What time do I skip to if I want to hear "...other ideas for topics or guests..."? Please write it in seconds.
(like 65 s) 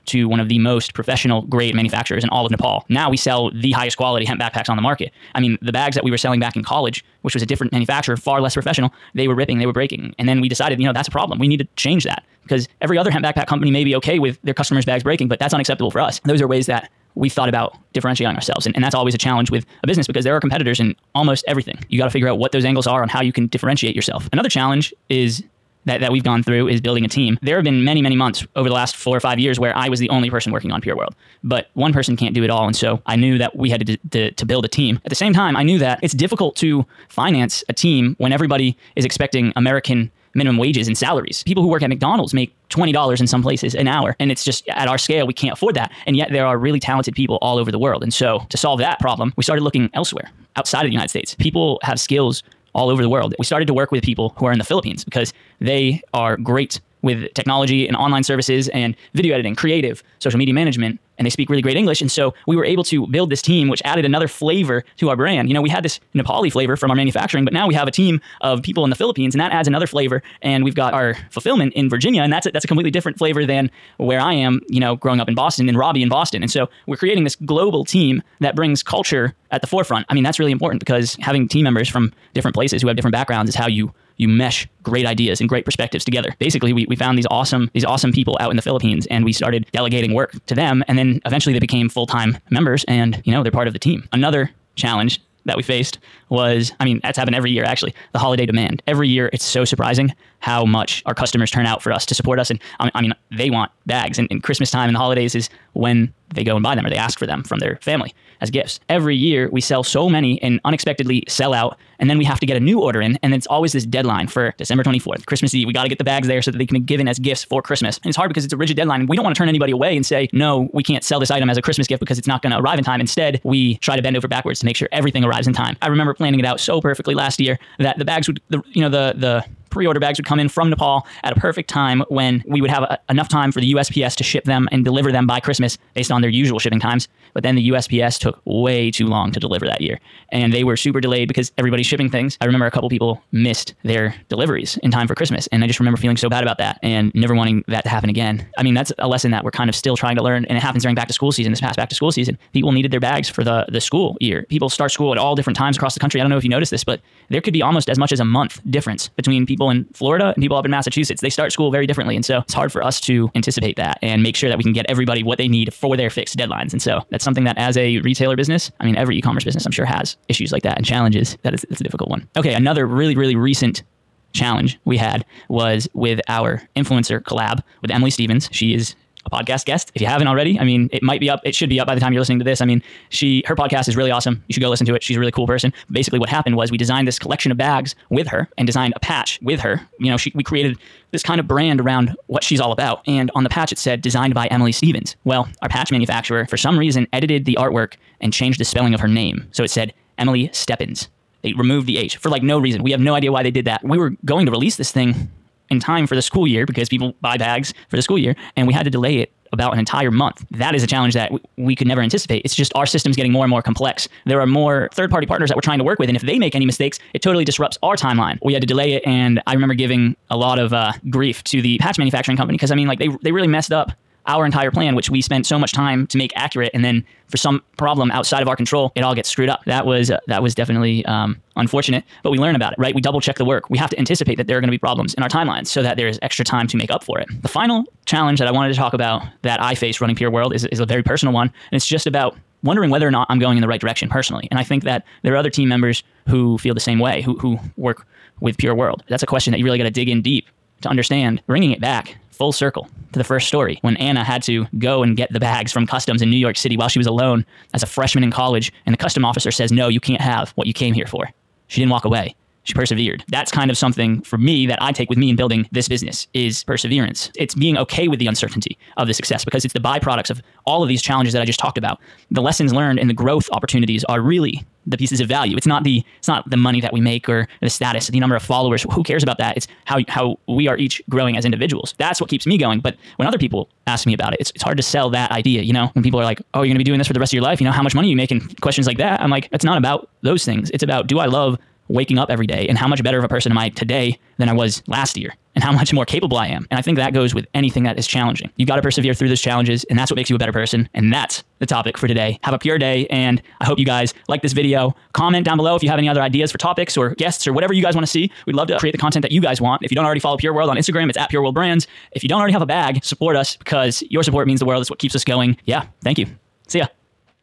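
306 s.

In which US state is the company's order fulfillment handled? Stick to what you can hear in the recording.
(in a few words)
Virginia.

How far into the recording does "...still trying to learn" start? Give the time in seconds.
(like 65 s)
149 s.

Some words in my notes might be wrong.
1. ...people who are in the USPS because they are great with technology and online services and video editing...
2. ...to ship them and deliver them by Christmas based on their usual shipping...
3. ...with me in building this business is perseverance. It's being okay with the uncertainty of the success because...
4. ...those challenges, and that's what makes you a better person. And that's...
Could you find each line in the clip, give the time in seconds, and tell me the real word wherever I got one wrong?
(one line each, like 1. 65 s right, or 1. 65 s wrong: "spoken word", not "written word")
1. 54 s wrong: "Philippines", not "USPS"
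2. 134 s right
3. 265 s right
4. 299 s right.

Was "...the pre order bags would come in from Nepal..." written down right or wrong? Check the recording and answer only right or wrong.
right.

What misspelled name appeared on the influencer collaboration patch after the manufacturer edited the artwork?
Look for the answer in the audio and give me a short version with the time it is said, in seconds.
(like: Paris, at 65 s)
Emily Steppins, at 200 s.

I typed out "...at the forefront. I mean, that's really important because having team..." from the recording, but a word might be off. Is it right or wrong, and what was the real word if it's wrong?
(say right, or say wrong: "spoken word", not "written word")
right.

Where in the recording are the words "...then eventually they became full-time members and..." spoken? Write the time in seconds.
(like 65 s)
90 s.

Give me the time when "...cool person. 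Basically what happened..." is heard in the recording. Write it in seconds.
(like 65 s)
185 s.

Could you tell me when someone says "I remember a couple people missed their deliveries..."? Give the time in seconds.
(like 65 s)
142 s.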